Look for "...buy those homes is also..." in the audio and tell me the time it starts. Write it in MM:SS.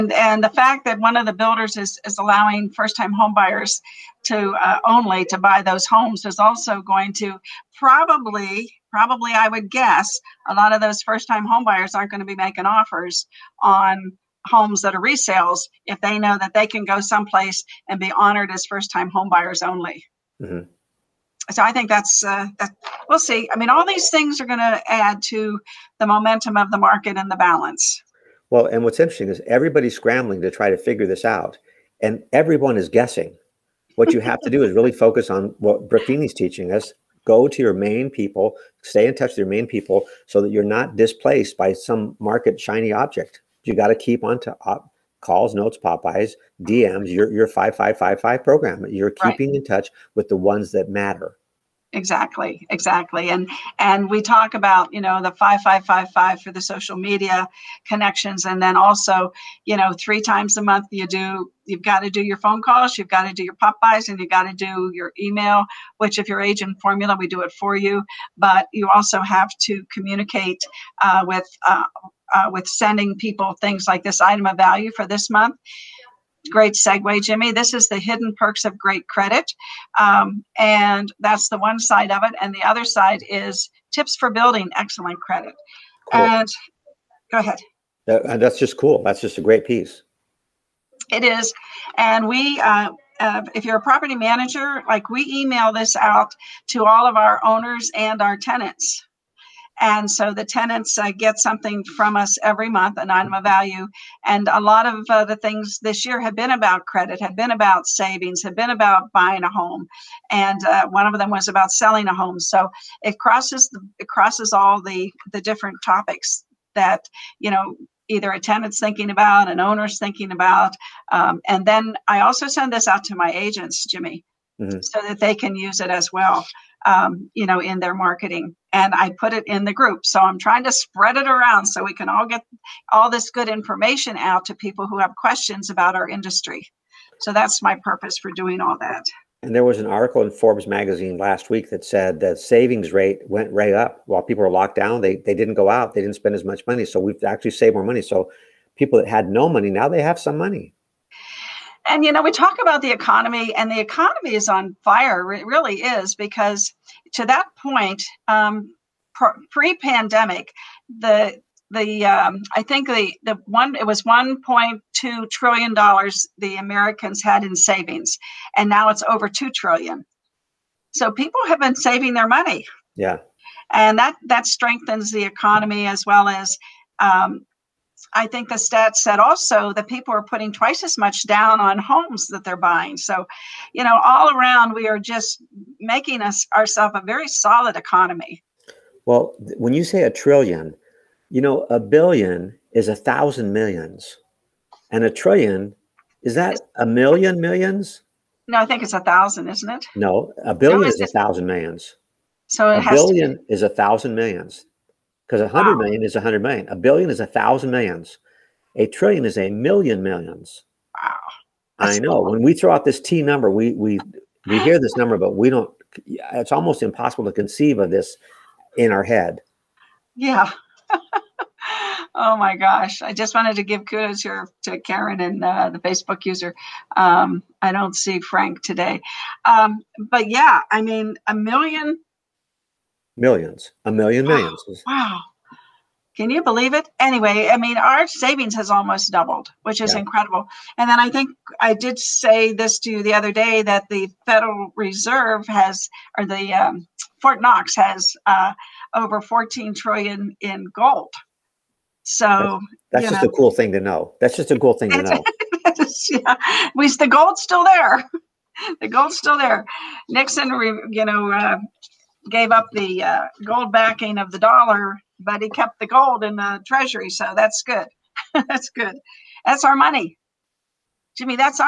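00:05.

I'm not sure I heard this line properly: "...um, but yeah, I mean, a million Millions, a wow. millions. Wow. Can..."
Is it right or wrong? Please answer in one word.
right.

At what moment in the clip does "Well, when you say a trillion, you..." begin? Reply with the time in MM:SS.
03:09.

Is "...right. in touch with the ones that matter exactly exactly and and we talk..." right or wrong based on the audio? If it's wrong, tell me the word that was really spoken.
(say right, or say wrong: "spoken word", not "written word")
right.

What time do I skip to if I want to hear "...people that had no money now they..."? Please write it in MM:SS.
02:28.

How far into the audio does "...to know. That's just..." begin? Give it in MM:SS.
04:13.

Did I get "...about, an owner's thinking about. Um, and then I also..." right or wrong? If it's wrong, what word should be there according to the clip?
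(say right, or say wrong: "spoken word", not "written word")
right.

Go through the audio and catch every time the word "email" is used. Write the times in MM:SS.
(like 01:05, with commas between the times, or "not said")
01:05, 01:35.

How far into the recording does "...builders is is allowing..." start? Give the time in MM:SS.
00:01.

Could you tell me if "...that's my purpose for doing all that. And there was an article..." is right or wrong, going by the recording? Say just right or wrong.
right.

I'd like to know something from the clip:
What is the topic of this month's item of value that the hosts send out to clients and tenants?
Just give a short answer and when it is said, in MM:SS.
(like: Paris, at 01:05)
The hidden perks of great credit, at 01:17.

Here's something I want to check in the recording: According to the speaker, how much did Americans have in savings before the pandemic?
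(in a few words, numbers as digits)
$1.2 trillion.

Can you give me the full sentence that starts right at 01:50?
And uh, one of them was about selling a home.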